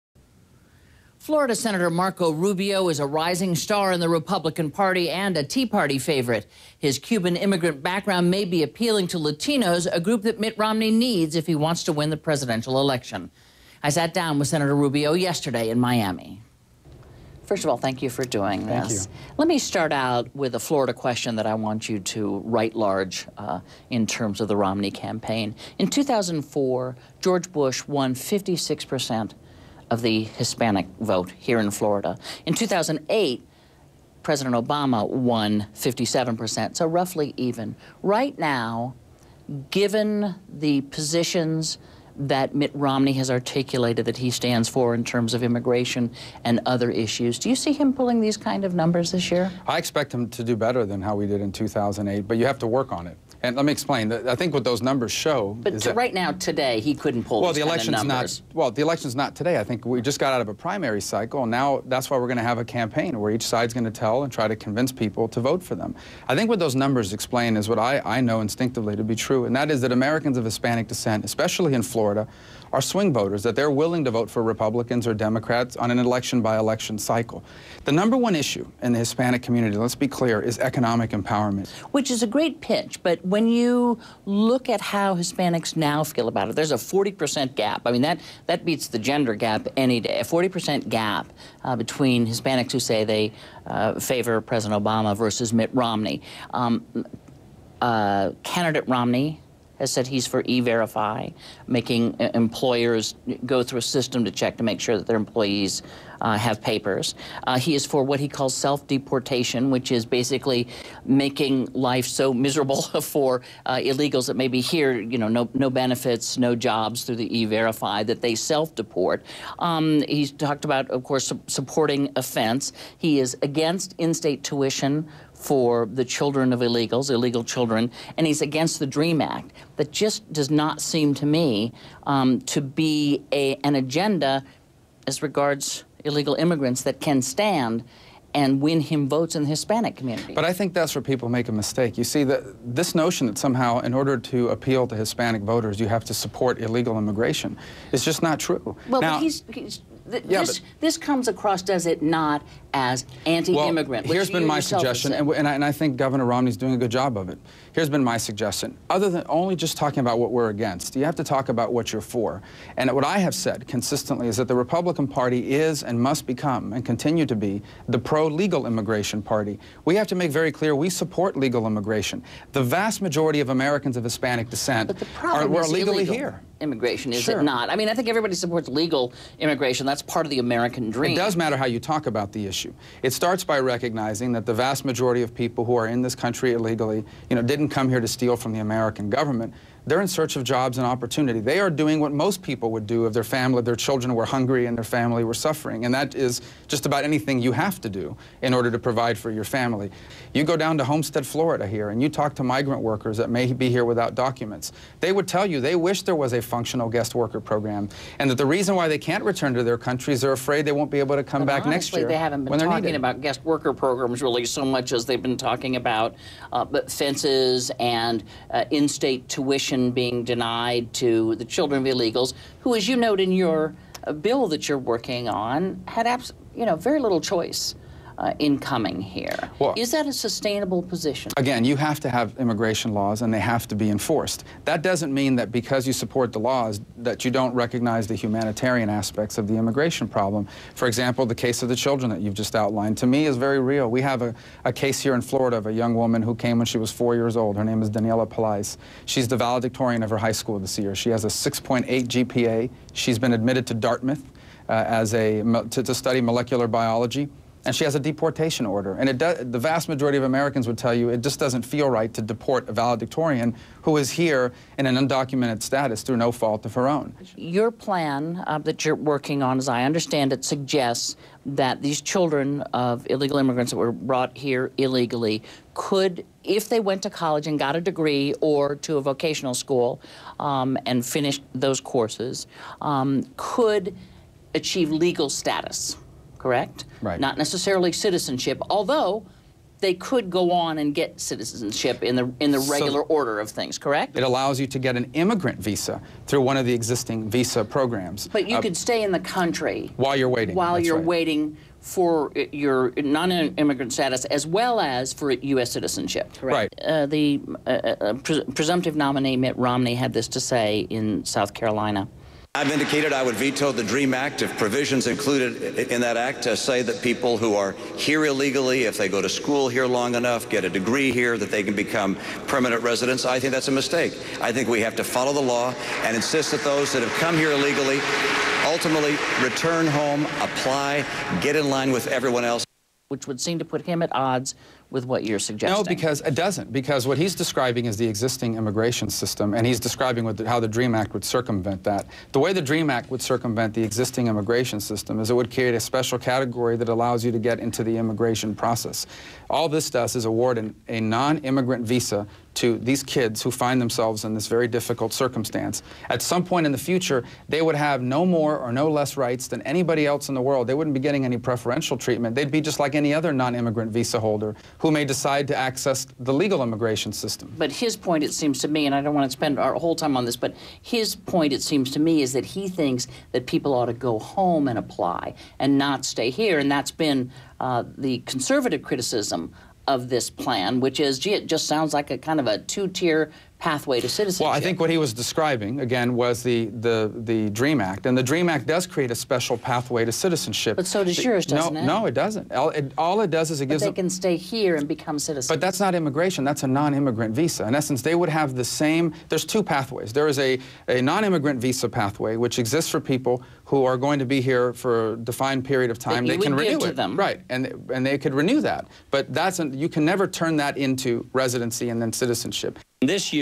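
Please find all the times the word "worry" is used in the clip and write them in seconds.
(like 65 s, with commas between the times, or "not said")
not said.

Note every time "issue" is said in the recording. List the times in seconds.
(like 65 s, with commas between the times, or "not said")
46 s, 78 s, 182 s.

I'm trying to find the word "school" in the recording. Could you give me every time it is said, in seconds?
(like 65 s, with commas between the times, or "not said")
250 s, 279 s, 319 s.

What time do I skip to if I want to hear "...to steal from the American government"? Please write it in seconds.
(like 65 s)
187 s.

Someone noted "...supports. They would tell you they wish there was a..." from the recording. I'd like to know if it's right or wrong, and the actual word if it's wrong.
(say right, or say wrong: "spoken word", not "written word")
wrong: "documents", not "supports".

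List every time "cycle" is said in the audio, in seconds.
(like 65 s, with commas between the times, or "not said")
61 s, 76 s.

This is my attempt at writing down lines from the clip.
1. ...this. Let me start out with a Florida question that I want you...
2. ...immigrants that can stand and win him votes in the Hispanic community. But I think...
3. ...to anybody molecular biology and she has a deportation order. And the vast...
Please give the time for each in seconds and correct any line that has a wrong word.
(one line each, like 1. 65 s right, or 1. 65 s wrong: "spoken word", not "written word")
1. 18 s right
2. 136 s right
3. 255 s wrong: "study", not "anybody".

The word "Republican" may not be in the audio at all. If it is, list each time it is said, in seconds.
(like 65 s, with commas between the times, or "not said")
4 s, 74 s, 164 s.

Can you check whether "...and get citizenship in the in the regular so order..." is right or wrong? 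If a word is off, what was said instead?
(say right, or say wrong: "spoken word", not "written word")
right.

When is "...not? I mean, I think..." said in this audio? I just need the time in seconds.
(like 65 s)
177 s.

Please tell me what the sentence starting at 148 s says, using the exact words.
Well, now, he's, he's Th yeah, this, this comes across, does it not, as anti-immigrant?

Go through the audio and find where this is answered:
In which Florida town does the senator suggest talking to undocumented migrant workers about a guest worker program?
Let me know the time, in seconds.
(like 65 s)
200 s.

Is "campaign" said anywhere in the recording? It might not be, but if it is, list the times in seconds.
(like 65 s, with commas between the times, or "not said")
24 s, 62 s.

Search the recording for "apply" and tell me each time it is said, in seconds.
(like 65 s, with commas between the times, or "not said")
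330 s, 374 s.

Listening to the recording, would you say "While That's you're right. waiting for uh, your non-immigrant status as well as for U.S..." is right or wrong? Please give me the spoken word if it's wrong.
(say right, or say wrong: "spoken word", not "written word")
right.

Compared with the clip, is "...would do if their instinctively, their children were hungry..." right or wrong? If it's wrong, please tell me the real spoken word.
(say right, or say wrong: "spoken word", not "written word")
wrong: "family", not "instinctively".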